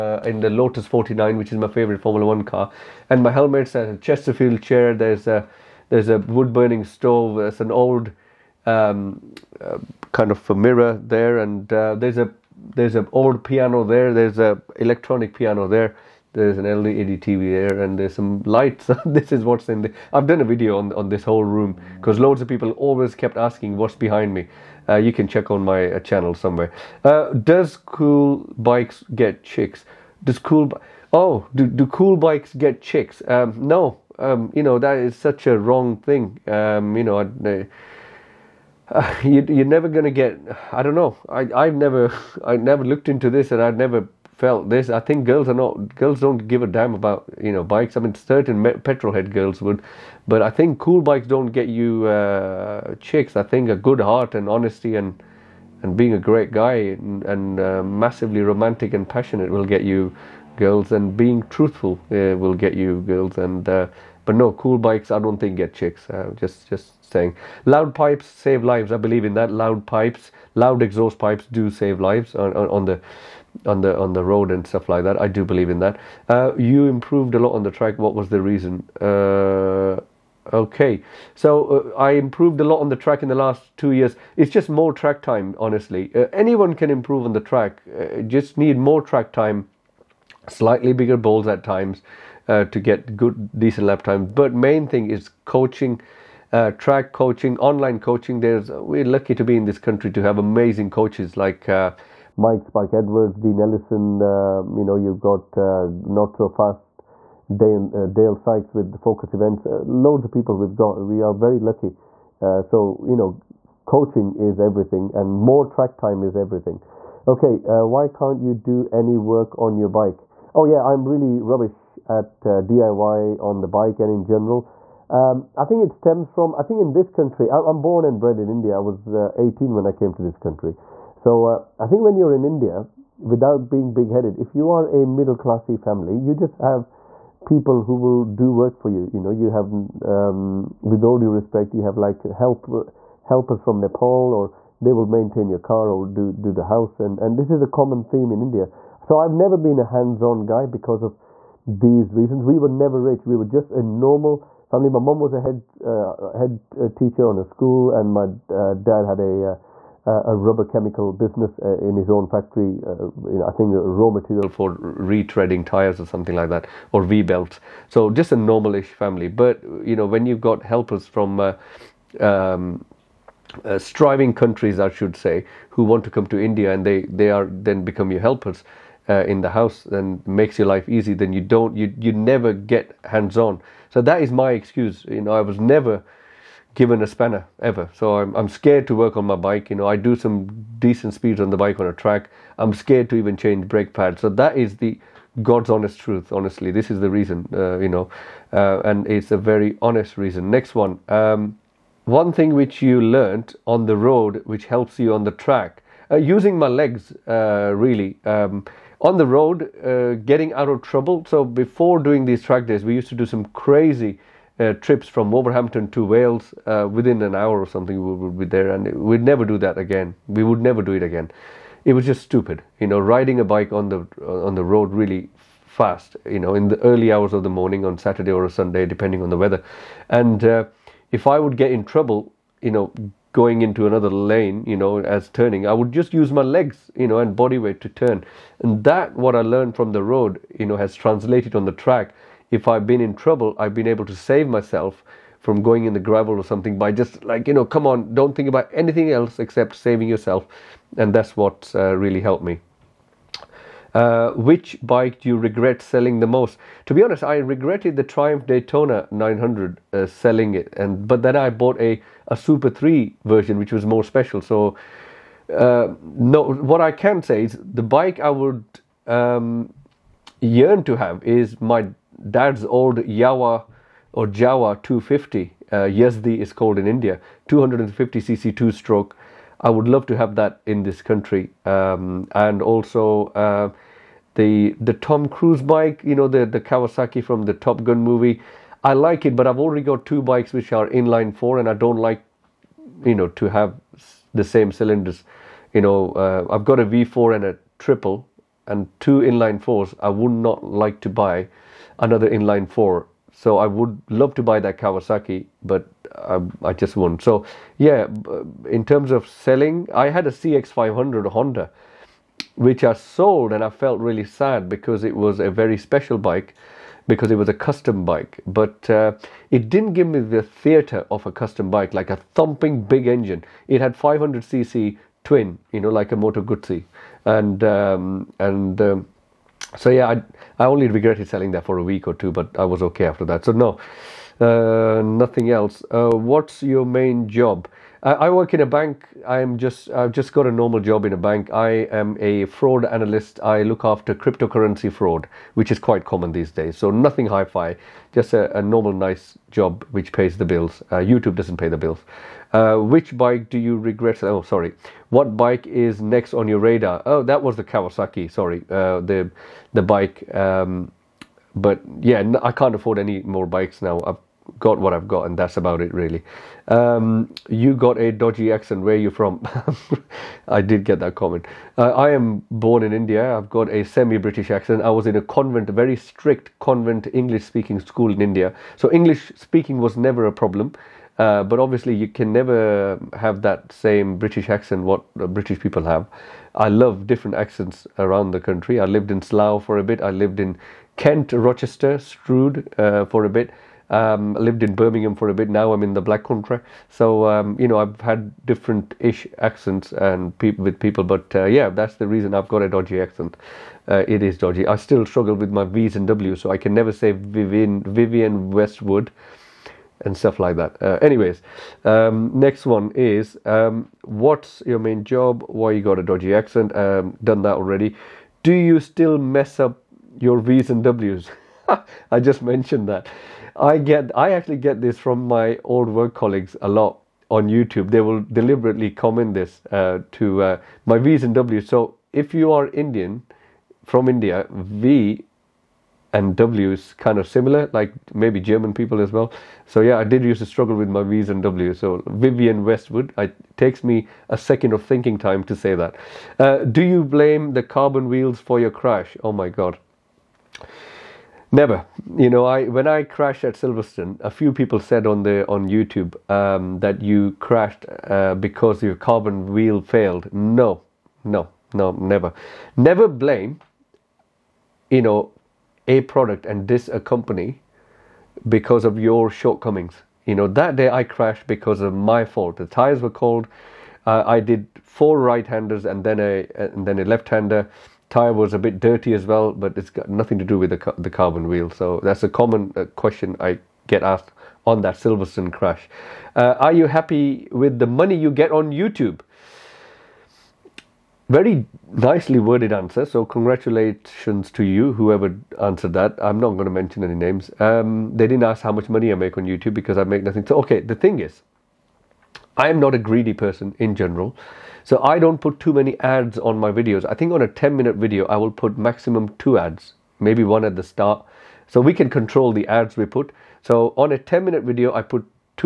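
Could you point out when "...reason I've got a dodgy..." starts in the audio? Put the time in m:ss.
6:42.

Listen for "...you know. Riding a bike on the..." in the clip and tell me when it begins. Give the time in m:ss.
3:42.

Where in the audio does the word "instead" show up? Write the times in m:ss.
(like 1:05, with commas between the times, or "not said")
not said.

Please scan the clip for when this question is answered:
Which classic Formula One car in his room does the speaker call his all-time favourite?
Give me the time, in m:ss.
0:00.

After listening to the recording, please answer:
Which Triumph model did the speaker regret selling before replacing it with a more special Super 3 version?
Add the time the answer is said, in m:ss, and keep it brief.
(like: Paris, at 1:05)
Triumph Daytona 900, at 4:18.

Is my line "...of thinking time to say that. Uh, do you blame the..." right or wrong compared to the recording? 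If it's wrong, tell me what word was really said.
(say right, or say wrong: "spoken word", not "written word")
right.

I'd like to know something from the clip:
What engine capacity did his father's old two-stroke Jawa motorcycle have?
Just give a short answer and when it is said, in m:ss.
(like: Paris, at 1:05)
250cc, at 4:37.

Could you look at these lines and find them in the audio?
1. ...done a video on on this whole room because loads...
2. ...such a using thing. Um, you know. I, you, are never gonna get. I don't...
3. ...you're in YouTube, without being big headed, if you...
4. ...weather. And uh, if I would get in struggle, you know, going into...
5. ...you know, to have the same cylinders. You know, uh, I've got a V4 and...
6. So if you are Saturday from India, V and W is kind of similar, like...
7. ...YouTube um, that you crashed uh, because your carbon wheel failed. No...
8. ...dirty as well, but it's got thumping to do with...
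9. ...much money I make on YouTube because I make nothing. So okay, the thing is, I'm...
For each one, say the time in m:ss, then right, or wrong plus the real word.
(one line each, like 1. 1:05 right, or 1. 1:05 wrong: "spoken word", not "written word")
1. 0:20 right
2. 0:35 wrong: "wrong", not "using"
3. 2:12 wrong: "India", not "YouTube"
4. 3:49 wrong: "trouble", not "struggle"
5. 4:53 right
6. 7:11 wrong: "Indian", not "Saturday"
7. 7:35 right
8. 7:58 wrong: "nothing", not "thumping"
9. 8:18 right.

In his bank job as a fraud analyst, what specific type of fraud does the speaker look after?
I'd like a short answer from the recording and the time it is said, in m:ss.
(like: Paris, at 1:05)
Cryptocurrency fraud, at 5:44.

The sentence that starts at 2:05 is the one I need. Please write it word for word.
Um, I think it stems from, I think in this country, I, am born and bred in India.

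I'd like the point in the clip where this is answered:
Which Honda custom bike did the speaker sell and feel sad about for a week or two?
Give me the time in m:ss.
5:10.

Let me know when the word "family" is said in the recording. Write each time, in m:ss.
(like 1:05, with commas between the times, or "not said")
2:15, 2:34, 2:48.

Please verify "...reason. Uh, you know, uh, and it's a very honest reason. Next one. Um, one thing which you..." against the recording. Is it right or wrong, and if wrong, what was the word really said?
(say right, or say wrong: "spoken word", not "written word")
right.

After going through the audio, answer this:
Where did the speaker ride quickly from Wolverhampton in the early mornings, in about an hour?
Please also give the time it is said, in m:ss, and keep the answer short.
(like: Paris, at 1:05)
Wales, at 3:36.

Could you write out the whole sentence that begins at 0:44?
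I think girls are not girls don't give a damn about you know bikes.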